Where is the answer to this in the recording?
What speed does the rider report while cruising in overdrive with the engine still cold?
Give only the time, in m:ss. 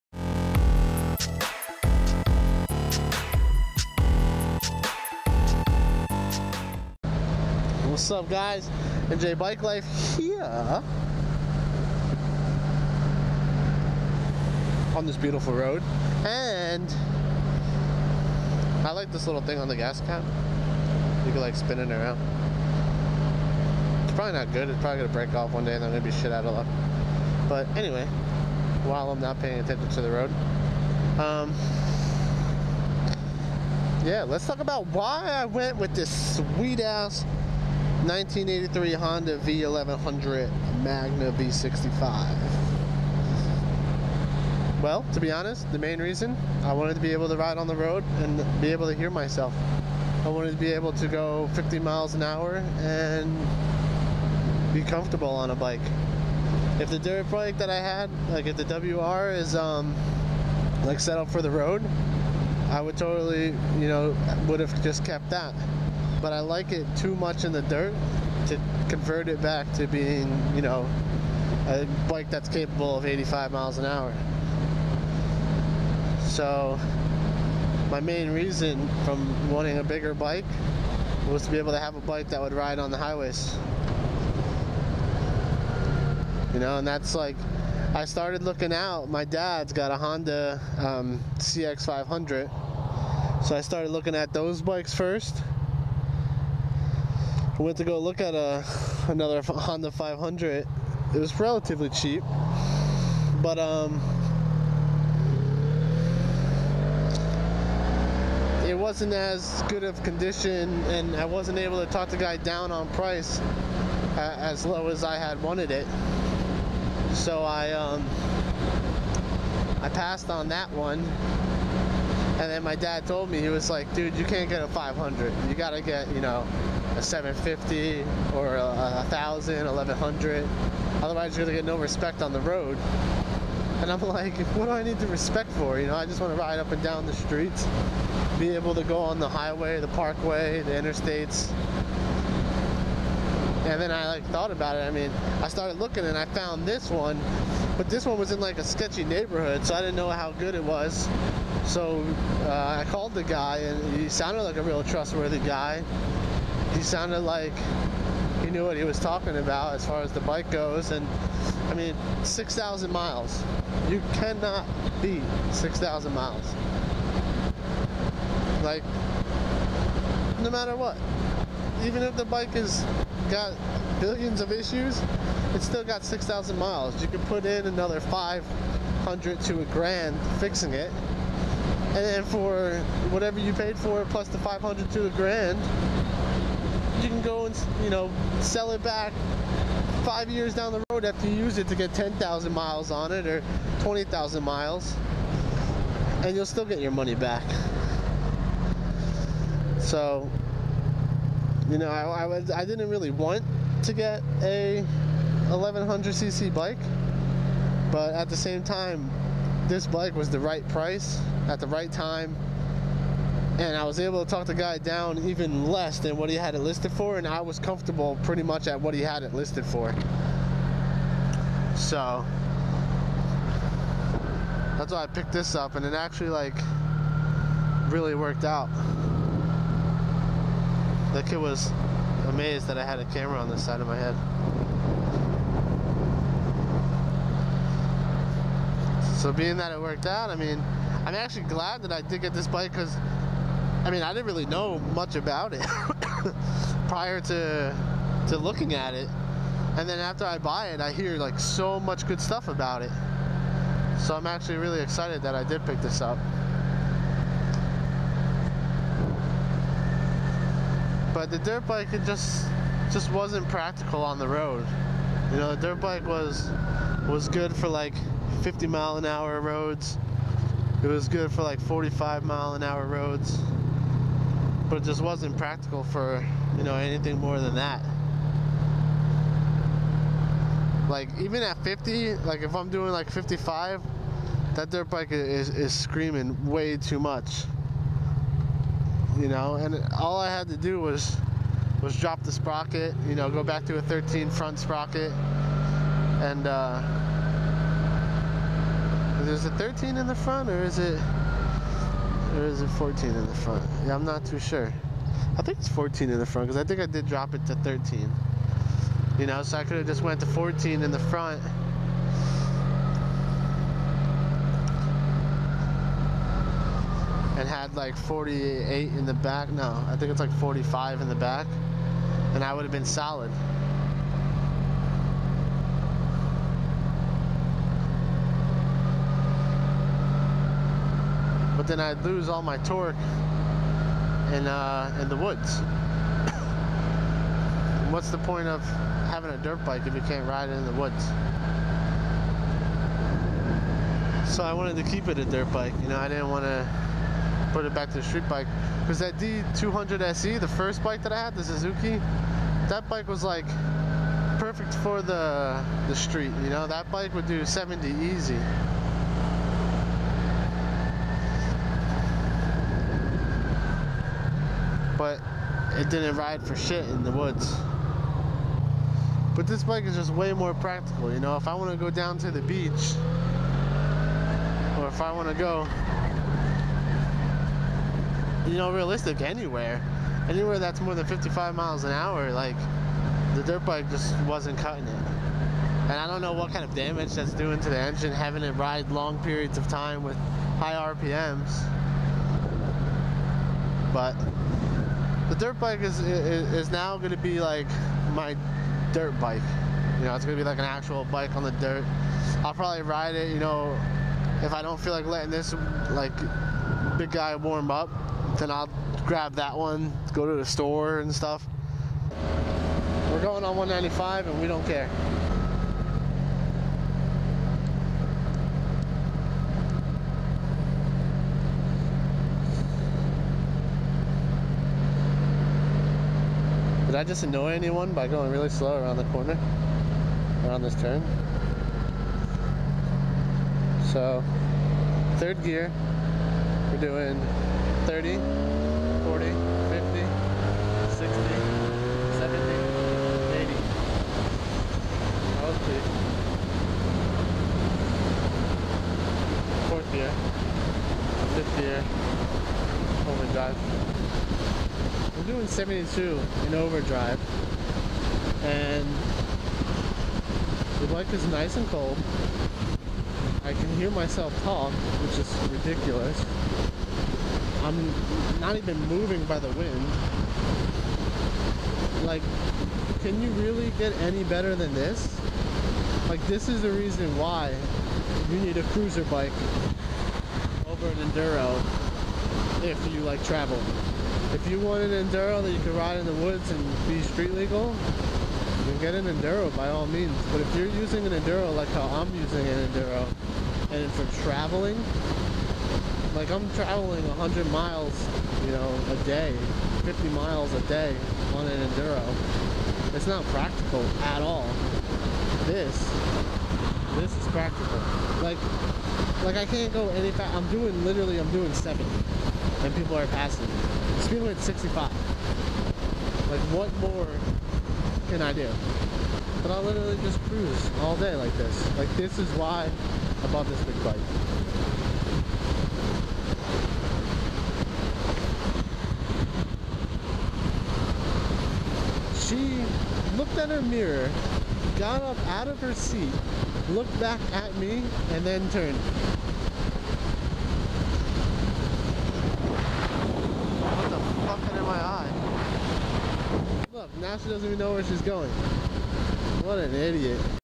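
7:35.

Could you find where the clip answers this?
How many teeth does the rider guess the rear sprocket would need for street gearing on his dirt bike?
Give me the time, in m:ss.
5:20.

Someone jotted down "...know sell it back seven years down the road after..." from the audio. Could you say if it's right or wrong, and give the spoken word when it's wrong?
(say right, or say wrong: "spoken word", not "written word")
wrong: "five", not "seven".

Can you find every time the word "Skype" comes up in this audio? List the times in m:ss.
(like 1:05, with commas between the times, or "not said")
not said.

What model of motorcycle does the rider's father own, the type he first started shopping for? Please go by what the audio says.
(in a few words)
Honda CX500.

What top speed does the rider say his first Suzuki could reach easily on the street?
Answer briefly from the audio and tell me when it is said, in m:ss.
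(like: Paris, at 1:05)
70, at 5:57.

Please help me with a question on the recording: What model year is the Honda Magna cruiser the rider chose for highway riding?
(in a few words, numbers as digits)
1983.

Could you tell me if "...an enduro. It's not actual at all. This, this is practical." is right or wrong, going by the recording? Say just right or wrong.
wrong.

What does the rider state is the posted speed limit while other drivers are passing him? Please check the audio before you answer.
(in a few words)
65.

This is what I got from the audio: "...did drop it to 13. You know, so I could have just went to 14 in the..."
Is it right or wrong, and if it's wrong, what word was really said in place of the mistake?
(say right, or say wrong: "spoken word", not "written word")
right.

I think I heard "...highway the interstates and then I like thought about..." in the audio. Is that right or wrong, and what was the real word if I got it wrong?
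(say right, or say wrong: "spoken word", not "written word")
wrong: "parkway", not "highway".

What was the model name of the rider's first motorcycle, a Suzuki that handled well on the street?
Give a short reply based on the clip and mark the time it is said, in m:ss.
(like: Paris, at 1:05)
D200 SE, at 5:49.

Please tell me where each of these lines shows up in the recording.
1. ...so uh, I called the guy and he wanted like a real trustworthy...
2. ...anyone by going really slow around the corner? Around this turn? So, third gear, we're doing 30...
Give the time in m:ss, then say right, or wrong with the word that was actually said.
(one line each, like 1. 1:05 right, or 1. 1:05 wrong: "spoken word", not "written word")
1. 2:31 wrong: "sounded", not "wanted"
2. 7:07 right.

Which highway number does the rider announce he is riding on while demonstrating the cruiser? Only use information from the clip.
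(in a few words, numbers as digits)
195.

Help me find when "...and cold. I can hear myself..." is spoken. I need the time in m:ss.
7:41.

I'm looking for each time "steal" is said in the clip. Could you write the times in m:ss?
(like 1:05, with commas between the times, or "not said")
not said.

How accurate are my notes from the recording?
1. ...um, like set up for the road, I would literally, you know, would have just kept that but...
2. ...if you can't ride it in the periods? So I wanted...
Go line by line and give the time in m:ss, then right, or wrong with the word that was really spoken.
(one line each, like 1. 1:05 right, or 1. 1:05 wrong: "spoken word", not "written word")
1. 0:59 wrong: "totally", not "literally"
2. 5:39 wrong: "woods", not "periods".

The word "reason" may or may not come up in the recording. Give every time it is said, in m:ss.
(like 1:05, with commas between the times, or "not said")
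0:46, 1:18, 7:56.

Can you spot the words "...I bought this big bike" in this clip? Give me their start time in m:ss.
8:43.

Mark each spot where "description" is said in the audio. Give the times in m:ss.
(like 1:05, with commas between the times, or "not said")
not said.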